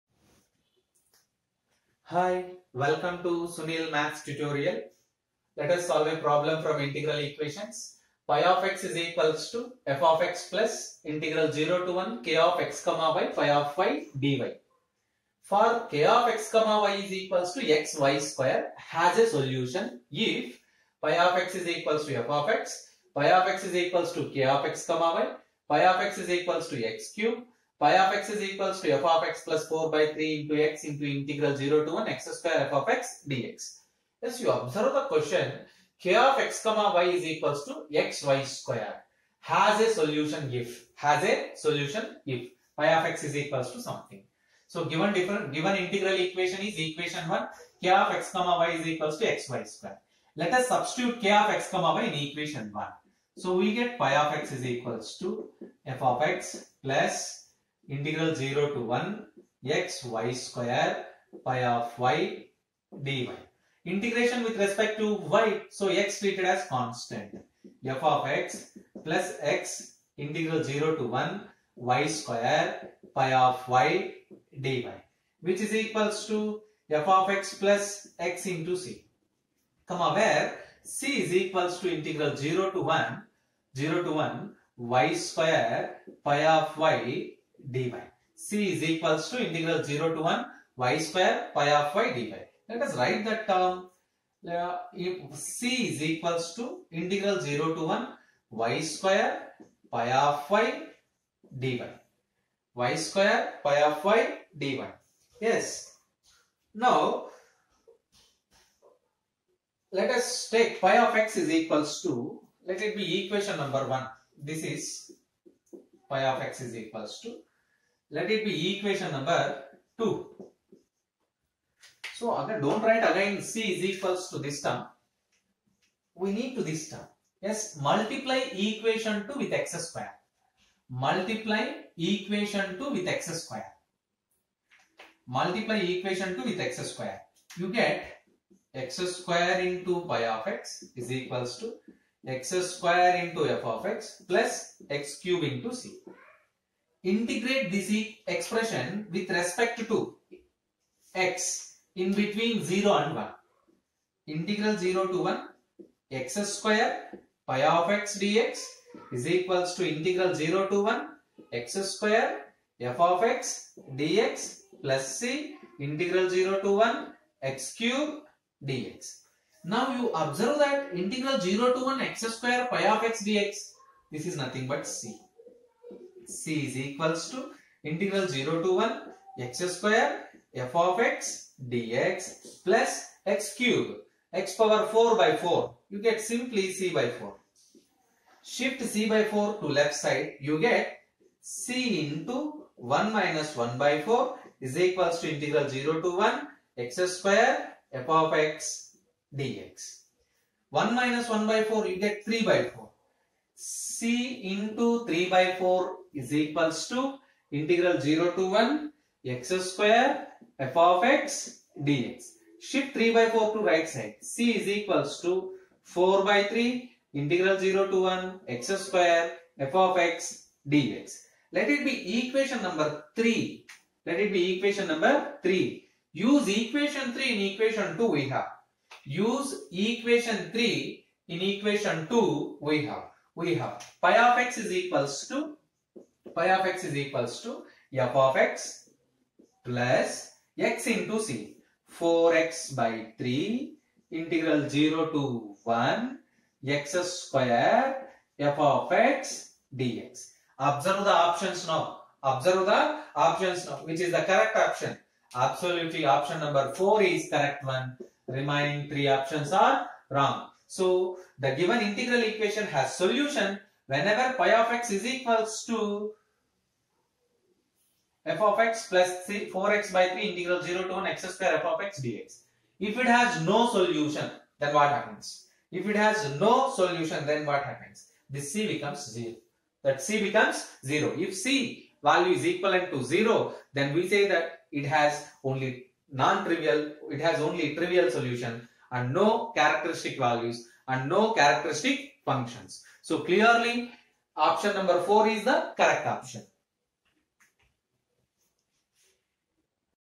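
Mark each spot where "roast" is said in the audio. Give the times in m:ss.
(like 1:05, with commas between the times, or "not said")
not said.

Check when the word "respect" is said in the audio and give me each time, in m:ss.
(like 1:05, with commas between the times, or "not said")
1:04, 2:29.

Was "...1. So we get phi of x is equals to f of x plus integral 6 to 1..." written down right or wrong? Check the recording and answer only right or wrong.
wrong.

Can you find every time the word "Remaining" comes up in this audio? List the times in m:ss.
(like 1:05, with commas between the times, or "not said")
4:18.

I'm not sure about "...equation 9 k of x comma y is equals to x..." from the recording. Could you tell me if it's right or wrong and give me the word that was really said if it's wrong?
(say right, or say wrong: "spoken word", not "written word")
wrong: "1", not "9".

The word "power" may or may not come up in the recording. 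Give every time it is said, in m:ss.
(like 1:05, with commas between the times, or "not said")
3:04.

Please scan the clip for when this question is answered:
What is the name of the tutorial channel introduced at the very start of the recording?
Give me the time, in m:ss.
0:03.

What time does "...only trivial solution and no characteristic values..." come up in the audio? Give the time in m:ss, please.
4:47.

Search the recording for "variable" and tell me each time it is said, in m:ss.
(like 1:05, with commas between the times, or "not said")
not said.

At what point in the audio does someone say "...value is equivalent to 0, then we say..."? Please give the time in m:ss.
4:42.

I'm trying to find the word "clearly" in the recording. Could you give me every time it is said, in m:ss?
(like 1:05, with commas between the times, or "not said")
4:53.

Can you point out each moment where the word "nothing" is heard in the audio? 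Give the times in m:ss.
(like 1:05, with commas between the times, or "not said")
2:54.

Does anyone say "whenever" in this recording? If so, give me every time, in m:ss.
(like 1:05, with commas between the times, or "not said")
4:23.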